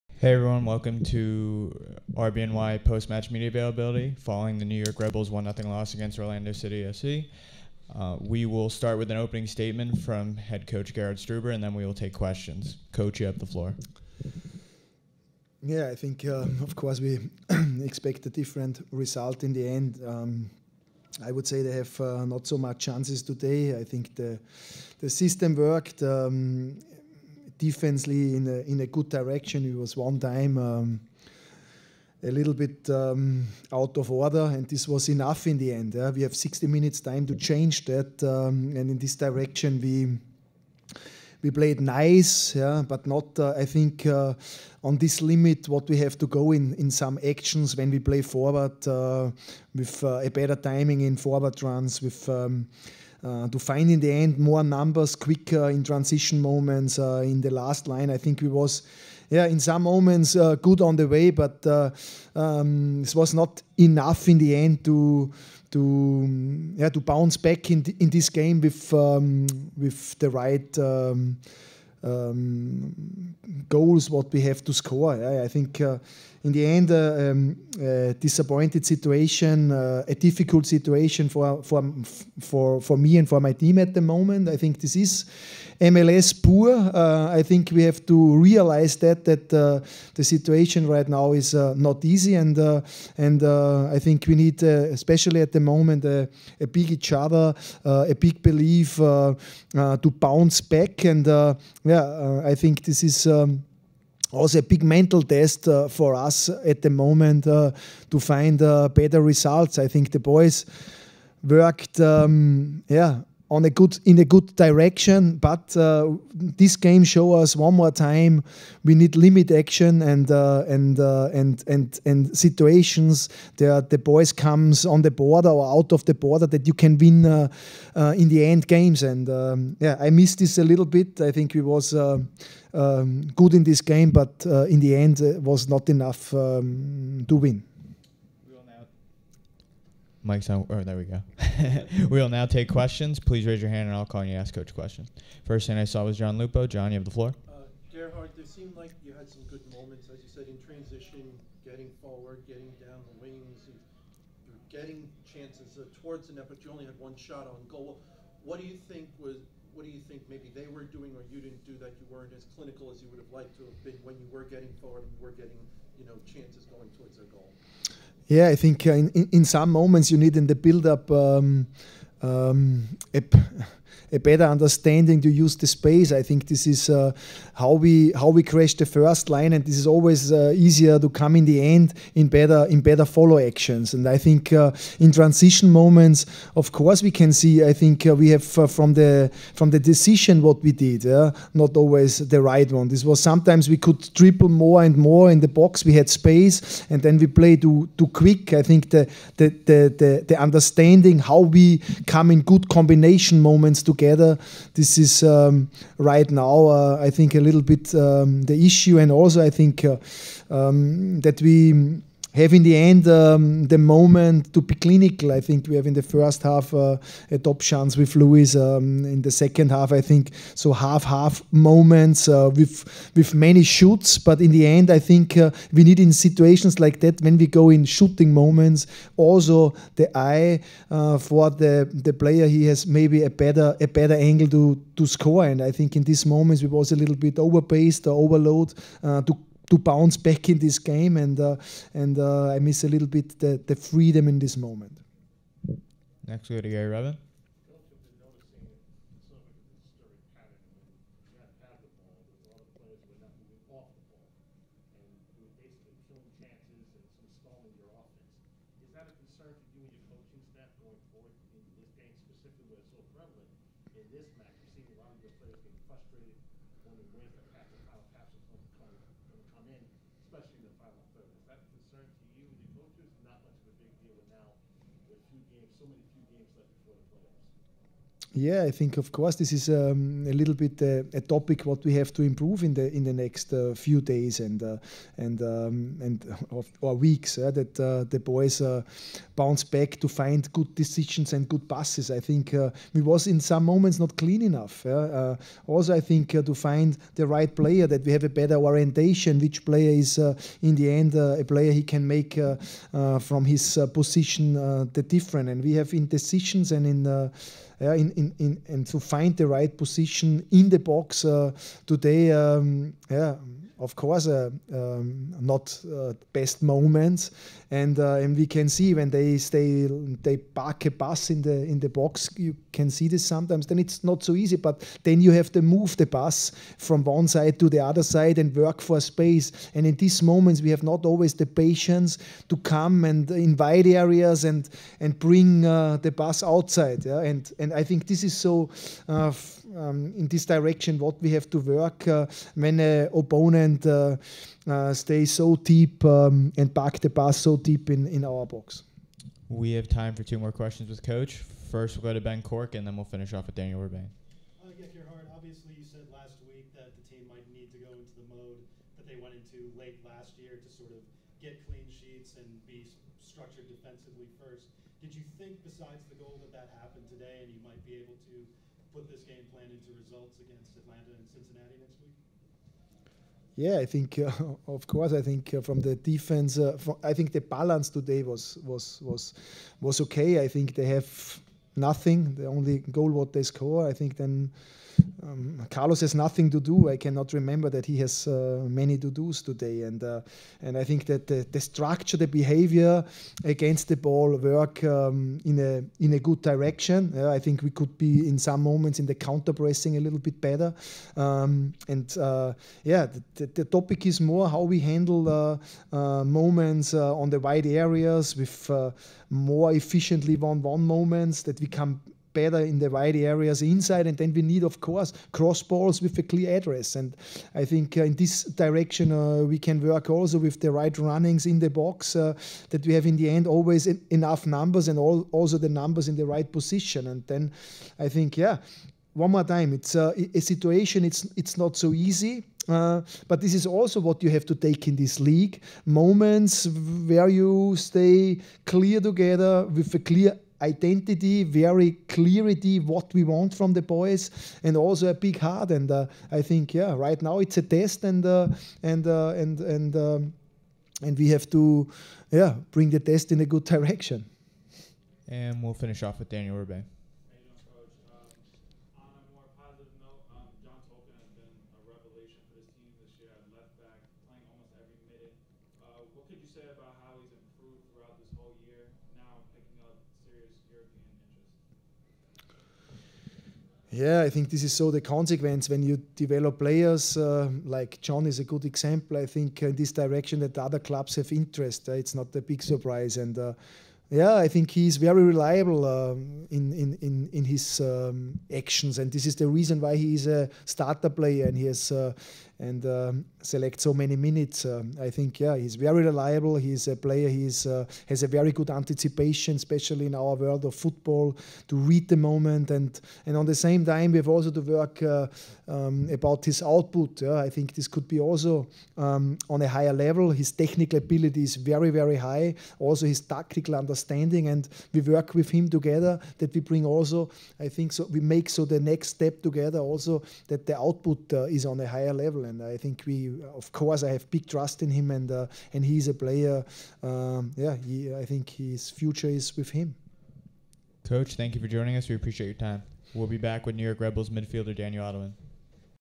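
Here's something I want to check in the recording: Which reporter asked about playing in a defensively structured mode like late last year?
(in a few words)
Ben Cork.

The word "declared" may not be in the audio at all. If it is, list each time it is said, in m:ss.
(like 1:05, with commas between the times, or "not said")
not said.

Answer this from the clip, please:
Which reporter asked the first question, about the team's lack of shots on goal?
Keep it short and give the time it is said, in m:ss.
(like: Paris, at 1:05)
John Lupo, at 2:26.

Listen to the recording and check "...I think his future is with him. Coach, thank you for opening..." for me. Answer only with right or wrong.
wrong.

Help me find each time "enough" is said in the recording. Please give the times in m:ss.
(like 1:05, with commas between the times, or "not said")
0:35, 1:03, 2:15, 4:54, 7:03.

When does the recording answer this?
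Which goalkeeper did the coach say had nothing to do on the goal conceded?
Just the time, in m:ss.
6:25.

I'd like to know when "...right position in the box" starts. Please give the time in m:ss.
5:09.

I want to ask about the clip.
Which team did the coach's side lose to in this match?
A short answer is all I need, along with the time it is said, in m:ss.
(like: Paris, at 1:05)
Orlando City FC, at 0:06.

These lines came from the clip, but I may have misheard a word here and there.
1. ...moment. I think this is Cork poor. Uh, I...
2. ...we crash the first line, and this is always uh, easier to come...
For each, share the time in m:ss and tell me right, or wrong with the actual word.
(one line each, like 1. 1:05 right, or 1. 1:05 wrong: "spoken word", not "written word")
1. 1:24 wrong: "MLS", not "Cork"
2. 2:58 right.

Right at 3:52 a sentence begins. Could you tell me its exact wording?
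He has maybe a better a better angle to to score.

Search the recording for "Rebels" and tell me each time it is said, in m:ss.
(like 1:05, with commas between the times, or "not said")
0:04.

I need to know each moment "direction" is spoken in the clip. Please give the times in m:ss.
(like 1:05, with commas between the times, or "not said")
0:29, 0:39, 1:54, 5:40, 6:36, 6:58, 7:33, 7:59.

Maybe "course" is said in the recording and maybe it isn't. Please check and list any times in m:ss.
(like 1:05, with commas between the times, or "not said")
0:16, 3:06, 4:39, 5:13, 6:14, 6:54, 8:43.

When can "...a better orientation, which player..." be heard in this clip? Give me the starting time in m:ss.
4:58.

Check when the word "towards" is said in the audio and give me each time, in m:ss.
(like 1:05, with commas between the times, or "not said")
2:36, 2:46.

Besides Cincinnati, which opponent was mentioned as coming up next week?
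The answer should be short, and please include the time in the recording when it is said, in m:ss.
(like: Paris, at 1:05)
Atlanta, at 6:10.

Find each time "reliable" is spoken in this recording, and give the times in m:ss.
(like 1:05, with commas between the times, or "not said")
8:05, 8:16.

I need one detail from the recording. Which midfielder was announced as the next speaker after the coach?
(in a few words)
Daniel Edelman.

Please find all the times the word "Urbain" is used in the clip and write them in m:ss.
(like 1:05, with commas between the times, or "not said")
5:53, 7:36.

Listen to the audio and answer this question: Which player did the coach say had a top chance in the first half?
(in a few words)
Lewis.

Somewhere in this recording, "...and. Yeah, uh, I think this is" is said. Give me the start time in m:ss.
1:41.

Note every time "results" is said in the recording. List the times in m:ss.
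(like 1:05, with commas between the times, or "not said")
0:18, 1:49, 6:10.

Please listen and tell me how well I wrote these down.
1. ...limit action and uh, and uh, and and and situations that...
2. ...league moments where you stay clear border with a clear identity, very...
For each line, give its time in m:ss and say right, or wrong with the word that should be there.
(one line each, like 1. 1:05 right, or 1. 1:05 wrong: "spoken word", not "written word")
1. 1:59 right
2. 7:15 wrong: "together", not "border".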